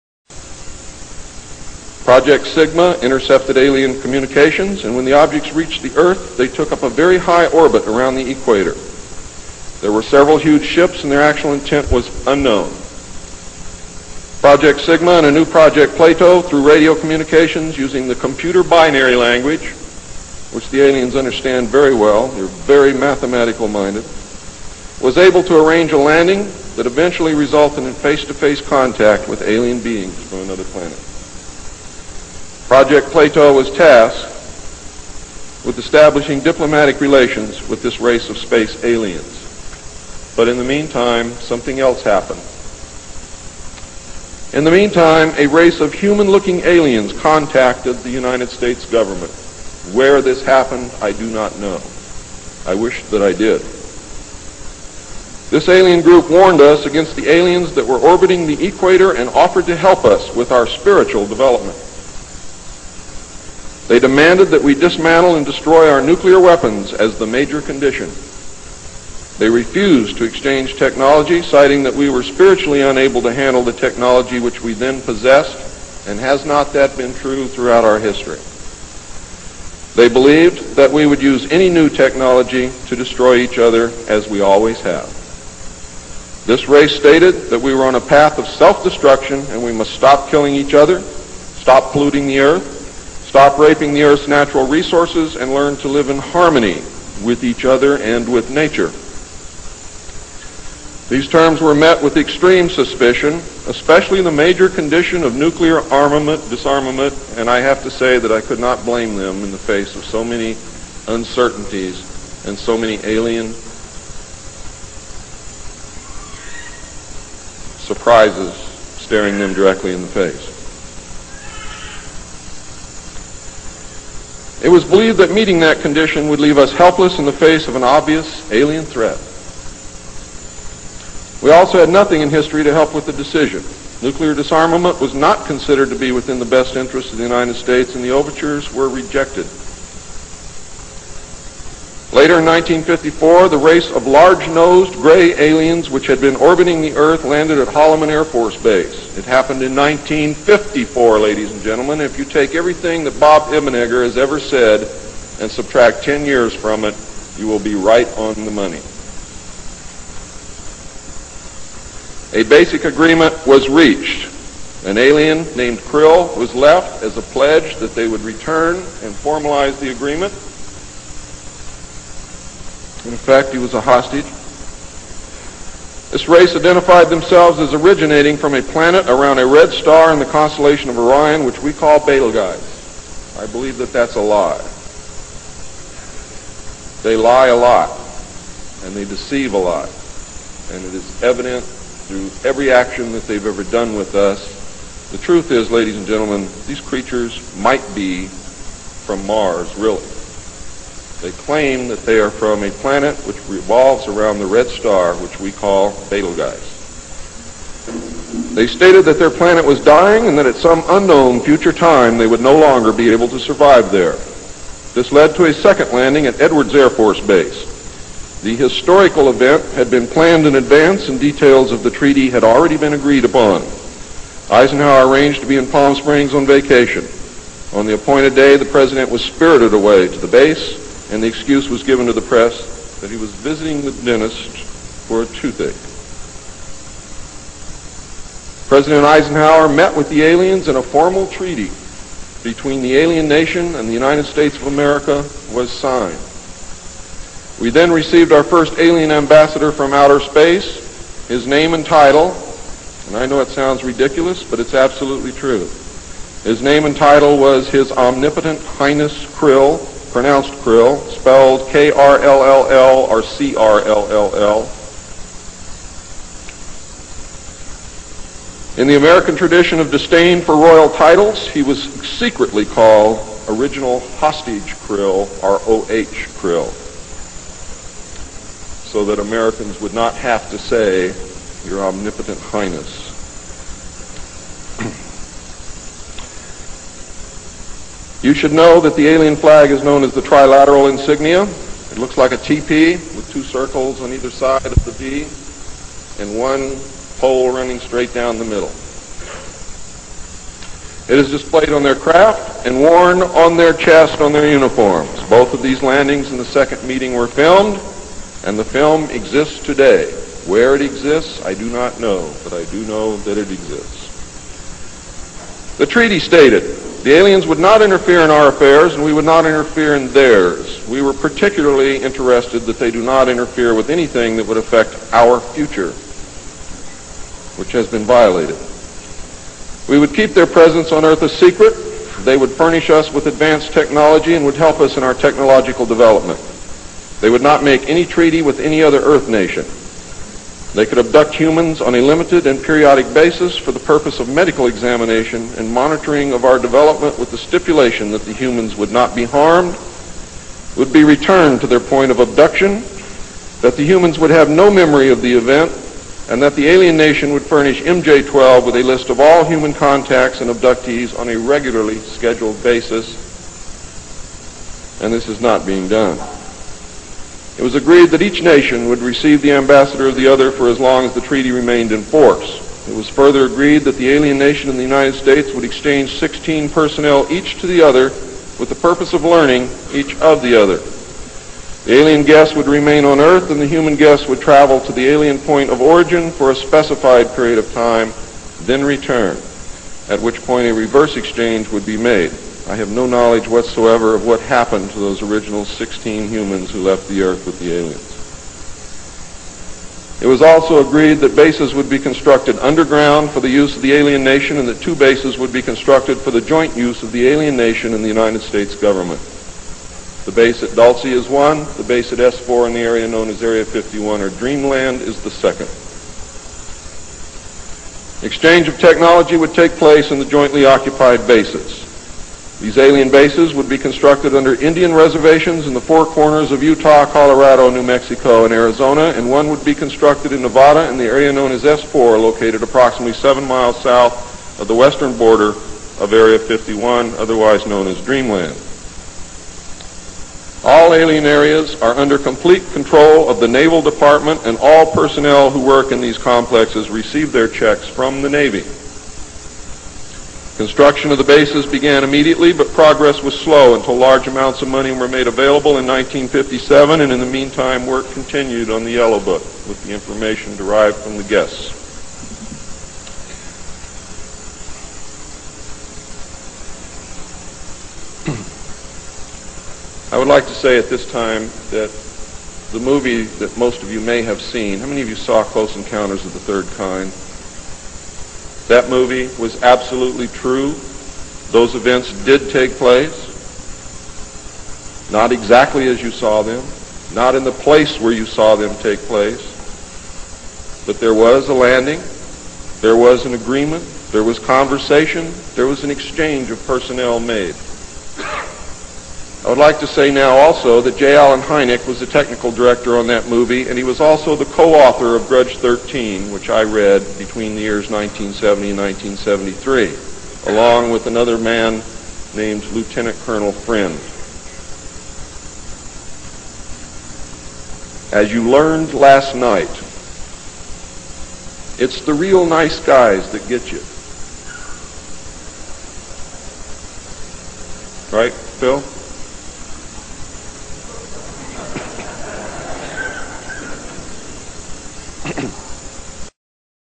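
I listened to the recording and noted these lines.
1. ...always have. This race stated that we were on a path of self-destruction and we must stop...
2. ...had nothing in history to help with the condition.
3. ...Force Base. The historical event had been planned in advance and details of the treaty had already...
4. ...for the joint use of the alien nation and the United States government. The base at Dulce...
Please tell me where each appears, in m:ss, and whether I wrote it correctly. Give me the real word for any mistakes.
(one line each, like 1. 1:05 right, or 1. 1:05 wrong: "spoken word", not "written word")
1. 1:24 right
2. 2:11 wrong: "decision", not "condition"
3. 3:36 right
4. 6:46 right.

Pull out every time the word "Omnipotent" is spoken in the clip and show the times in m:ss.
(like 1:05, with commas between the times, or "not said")
4:17, 4:41.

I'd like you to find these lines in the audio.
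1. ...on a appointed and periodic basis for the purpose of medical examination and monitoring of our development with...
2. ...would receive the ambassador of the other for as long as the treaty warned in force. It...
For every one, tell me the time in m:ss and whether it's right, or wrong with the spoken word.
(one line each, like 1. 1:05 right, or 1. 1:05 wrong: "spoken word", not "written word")
1. 5:41 wrong: "limited", not "appointed"
2. 6:08 wrong: "remained", not "warned".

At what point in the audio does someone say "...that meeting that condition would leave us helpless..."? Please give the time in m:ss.
2:05.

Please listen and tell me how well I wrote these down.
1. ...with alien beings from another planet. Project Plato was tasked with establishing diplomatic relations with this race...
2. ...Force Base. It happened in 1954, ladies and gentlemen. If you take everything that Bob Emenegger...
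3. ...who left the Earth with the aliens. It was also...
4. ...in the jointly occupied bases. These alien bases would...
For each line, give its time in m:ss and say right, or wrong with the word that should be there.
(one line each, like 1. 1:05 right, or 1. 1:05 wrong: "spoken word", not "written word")
1. 0:29 right
2. 2:28 right
3. 6:36 right
4. 7:00 right.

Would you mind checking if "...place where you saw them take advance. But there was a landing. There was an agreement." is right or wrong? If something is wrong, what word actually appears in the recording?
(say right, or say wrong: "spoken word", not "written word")
wrong: "place", not "advance".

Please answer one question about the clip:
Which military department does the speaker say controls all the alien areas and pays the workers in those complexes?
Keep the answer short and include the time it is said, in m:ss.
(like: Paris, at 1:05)
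Naval Department, at 7:23.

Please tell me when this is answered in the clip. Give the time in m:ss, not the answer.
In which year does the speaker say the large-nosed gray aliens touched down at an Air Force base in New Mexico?
2:22.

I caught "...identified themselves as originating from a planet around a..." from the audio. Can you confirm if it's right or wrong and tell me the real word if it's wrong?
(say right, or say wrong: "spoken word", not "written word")
right.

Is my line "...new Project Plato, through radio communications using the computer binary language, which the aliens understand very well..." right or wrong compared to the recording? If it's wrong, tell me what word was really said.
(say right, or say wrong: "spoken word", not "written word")
right.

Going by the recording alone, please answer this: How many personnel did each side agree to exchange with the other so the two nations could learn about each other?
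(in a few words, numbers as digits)
16.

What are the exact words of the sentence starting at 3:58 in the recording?
President Eisenhower met with the aliens and a formal treaty between the alien nation and the United States of America was signed.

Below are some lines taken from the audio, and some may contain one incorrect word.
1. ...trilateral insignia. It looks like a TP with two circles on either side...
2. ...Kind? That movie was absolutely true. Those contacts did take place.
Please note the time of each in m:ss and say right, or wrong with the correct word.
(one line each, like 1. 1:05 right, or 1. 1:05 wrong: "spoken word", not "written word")
1. 4:50 right
2. 7:56 wrong: "events", not "contacts".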